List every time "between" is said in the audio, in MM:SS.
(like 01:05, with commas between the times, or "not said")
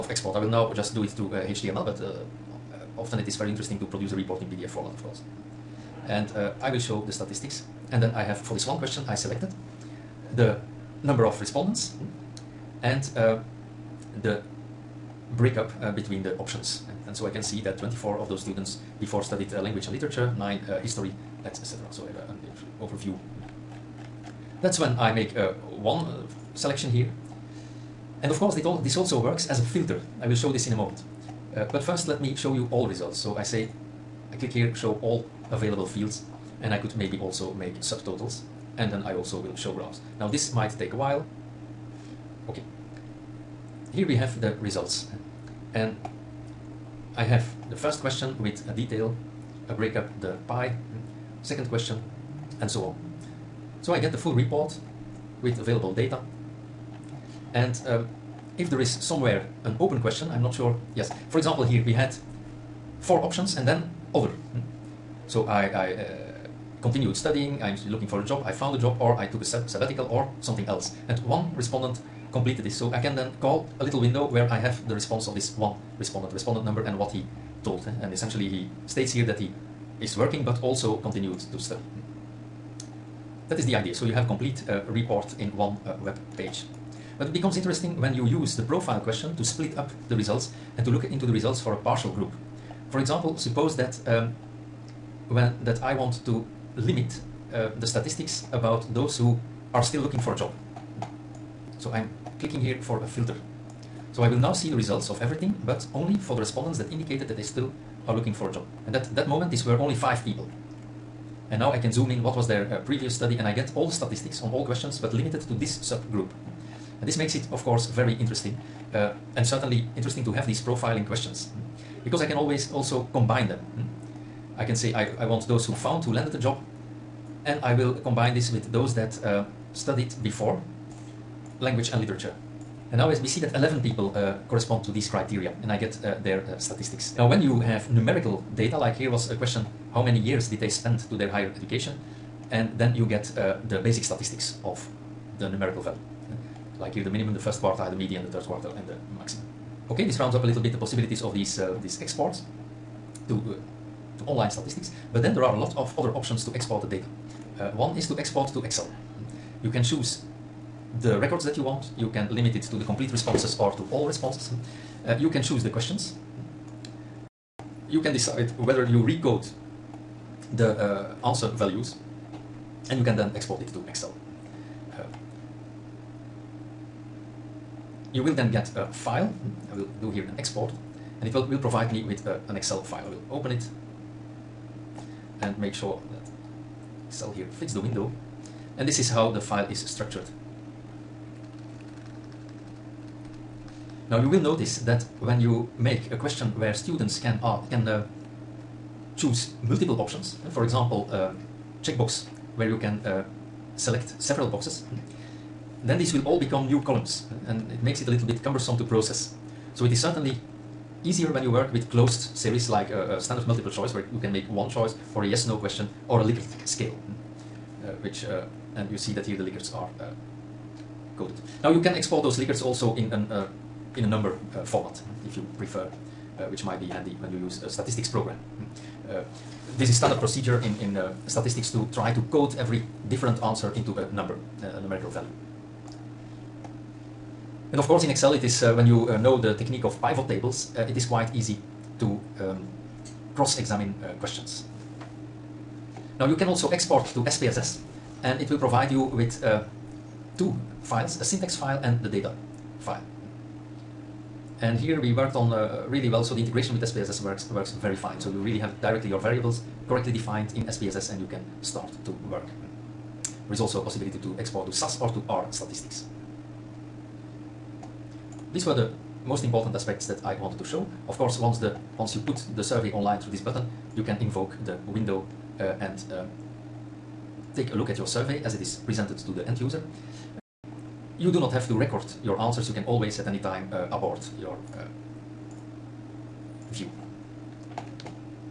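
00:15.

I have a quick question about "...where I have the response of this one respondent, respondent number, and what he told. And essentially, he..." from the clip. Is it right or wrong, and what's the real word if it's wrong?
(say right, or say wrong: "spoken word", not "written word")
right.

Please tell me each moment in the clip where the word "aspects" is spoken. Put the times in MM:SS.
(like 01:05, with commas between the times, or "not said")
04:29.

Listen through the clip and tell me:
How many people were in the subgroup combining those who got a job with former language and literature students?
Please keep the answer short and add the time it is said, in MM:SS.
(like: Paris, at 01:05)
11, at 02:13.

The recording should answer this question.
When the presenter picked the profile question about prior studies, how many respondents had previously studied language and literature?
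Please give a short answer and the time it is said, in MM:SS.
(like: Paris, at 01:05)
24, at 00:17.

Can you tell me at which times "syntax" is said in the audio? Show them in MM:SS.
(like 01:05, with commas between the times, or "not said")
04:11.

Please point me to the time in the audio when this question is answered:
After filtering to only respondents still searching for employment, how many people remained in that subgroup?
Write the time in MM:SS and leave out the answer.
01:49.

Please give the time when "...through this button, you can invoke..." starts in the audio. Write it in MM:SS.
04:33.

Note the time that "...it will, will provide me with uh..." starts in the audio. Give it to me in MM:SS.
03:01.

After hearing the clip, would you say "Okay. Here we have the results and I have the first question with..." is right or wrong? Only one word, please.
right.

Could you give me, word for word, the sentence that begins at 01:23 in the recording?
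So you have a complete uh, report in one uh, web page.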